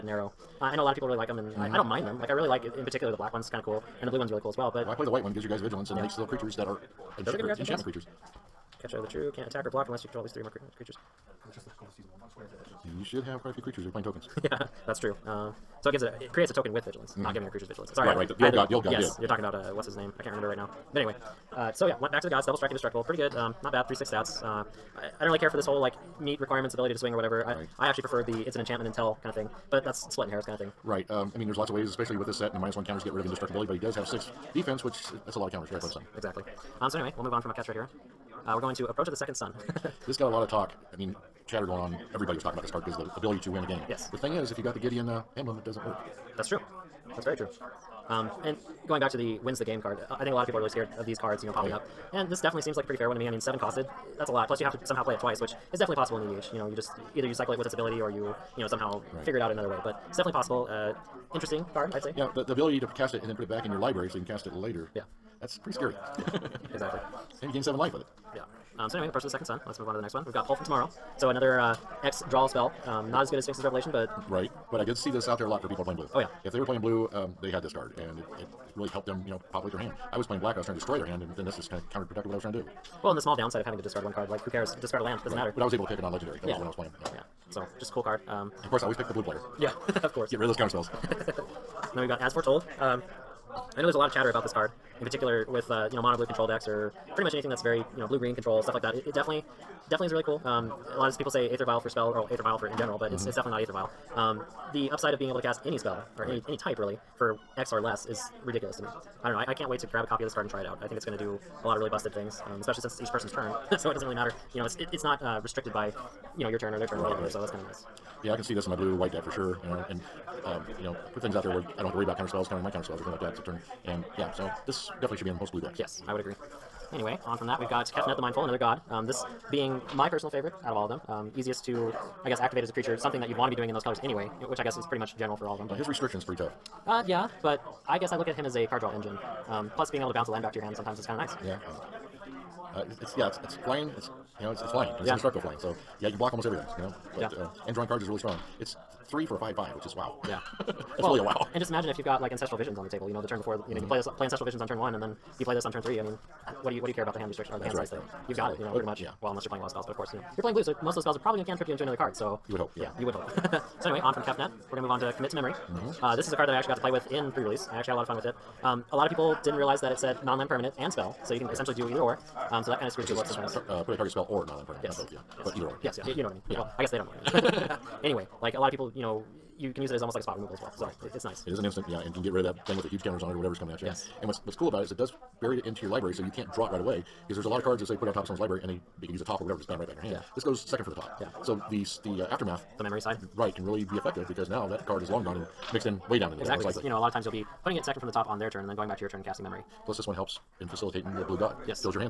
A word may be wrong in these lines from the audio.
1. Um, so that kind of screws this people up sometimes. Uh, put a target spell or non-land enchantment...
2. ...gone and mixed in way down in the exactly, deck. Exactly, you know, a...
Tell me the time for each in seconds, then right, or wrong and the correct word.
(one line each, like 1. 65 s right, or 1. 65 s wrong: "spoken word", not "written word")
1. 172 s wrong: "permanent", not "enchantment"
2. 195 s right.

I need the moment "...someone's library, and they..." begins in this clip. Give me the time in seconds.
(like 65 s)
188 s.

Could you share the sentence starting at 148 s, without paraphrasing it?
It's three for a five five, which is wow.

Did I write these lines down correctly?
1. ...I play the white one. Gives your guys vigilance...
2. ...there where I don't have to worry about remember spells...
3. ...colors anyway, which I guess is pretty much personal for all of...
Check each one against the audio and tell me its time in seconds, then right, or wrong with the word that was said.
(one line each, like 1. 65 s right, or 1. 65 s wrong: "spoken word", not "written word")
1. 4 s right
2. 121 s wrong: "counter", not "remember"
3. 133 s wrong: "general", not "personal".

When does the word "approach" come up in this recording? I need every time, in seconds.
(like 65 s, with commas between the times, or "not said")
38 s, 69 s.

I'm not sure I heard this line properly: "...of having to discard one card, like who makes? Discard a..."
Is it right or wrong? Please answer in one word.
wrong.